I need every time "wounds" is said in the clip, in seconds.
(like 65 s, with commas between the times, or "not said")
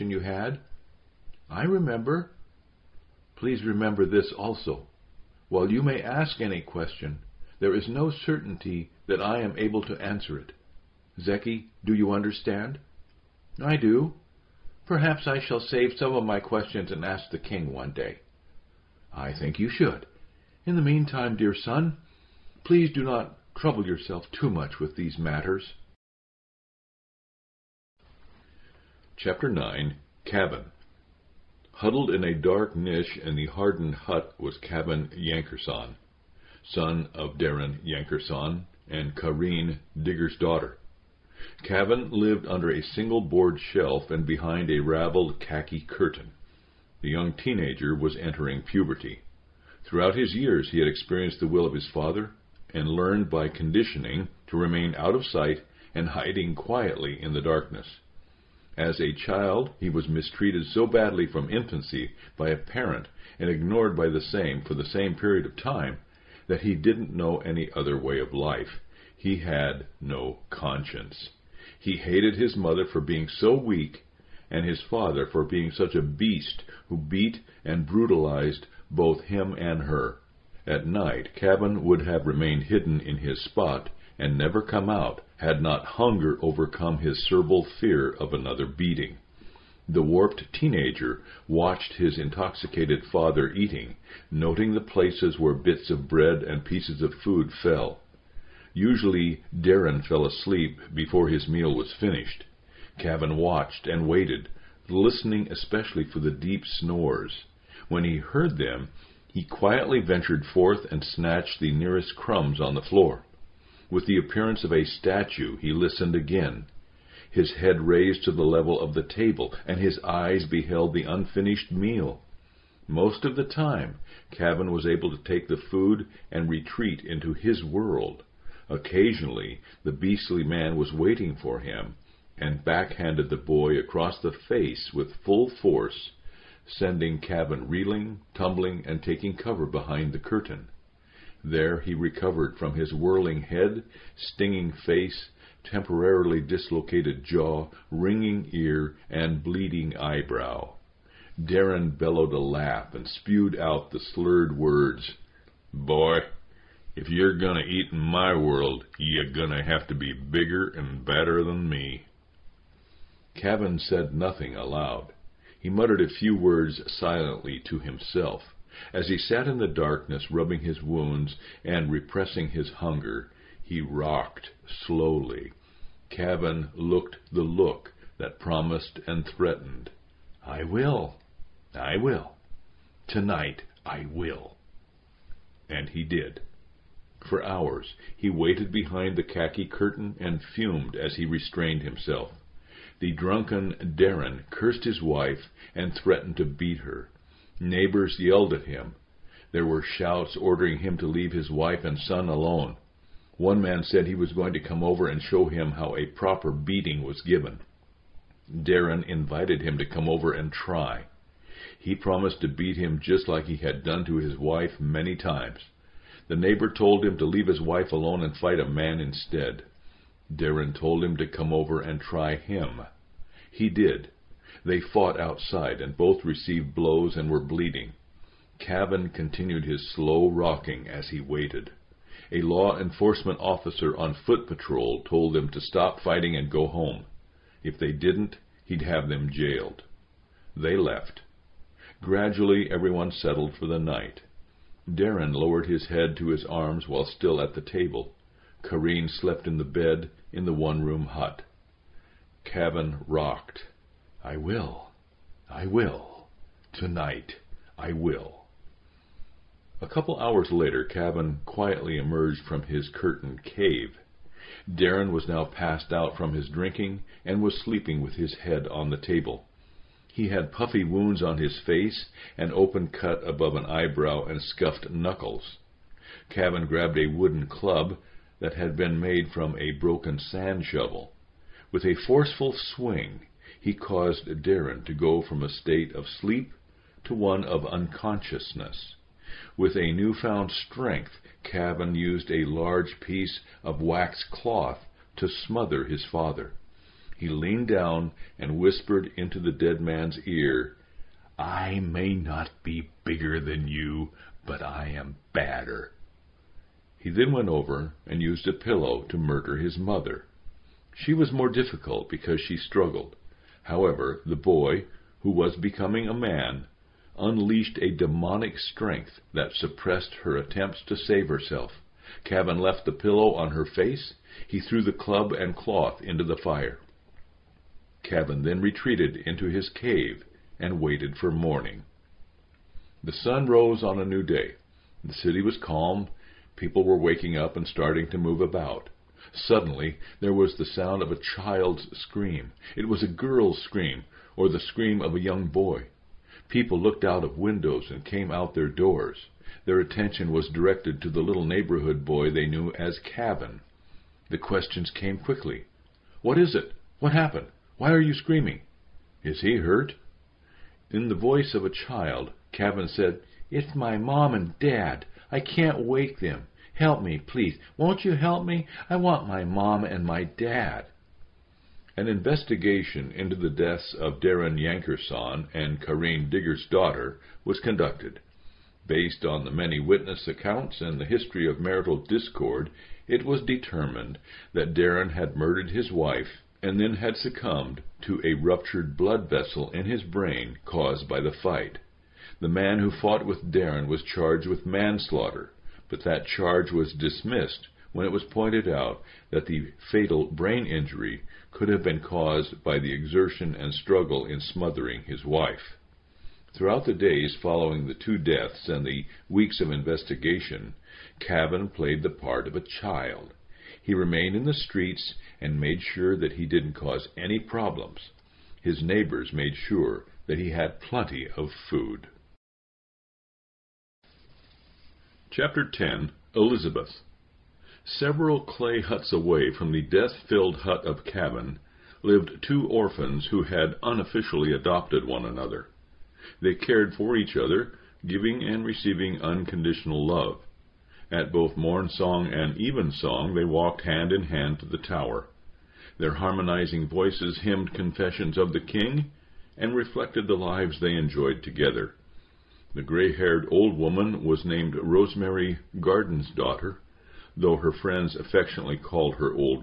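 170 s, 270 s.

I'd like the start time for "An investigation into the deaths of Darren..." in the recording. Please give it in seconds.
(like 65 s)
371 s.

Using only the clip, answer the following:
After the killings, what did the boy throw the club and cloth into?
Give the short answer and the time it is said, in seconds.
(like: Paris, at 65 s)
The fire, at 326 s.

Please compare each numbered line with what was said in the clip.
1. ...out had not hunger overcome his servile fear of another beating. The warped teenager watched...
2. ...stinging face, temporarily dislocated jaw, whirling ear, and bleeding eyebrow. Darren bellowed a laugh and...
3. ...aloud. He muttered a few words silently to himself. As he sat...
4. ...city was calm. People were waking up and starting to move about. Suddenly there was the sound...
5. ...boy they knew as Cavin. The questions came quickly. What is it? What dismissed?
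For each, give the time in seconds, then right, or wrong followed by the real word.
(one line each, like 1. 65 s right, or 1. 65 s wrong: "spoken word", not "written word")
1. 84 s right
2. 144 s wrong: "ringing", not "whirling"
3. 164 s right
4. 335 s right
5. 352 s wrong: "happened", not "dismissed".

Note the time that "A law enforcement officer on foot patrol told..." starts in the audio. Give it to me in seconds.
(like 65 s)
232 s.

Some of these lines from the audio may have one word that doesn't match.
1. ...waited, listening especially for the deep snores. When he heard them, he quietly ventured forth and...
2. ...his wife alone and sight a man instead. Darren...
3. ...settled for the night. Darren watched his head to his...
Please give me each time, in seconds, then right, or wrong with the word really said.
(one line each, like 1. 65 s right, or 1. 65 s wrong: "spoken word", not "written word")
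1. 104 s right
2. 217 s wrong: "fight", not "sight"
3. 243 s wrong: "lowered", not "watched".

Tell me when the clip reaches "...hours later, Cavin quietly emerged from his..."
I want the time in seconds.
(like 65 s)
260 s.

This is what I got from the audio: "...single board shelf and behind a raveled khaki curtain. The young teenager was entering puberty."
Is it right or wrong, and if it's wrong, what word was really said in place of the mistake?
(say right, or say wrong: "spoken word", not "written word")
right.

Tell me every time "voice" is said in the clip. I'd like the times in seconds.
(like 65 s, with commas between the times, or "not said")
361 s, 446 s.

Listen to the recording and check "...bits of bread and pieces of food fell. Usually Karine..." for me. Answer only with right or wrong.
wrong.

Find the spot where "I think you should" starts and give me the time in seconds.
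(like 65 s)
19 s.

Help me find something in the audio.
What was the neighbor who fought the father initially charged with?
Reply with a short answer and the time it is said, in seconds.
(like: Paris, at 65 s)
Manslaughter, at 394 s.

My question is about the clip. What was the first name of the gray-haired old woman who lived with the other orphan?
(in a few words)
Rosemary.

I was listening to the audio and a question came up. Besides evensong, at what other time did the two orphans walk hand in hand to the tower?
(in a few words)
Morn song.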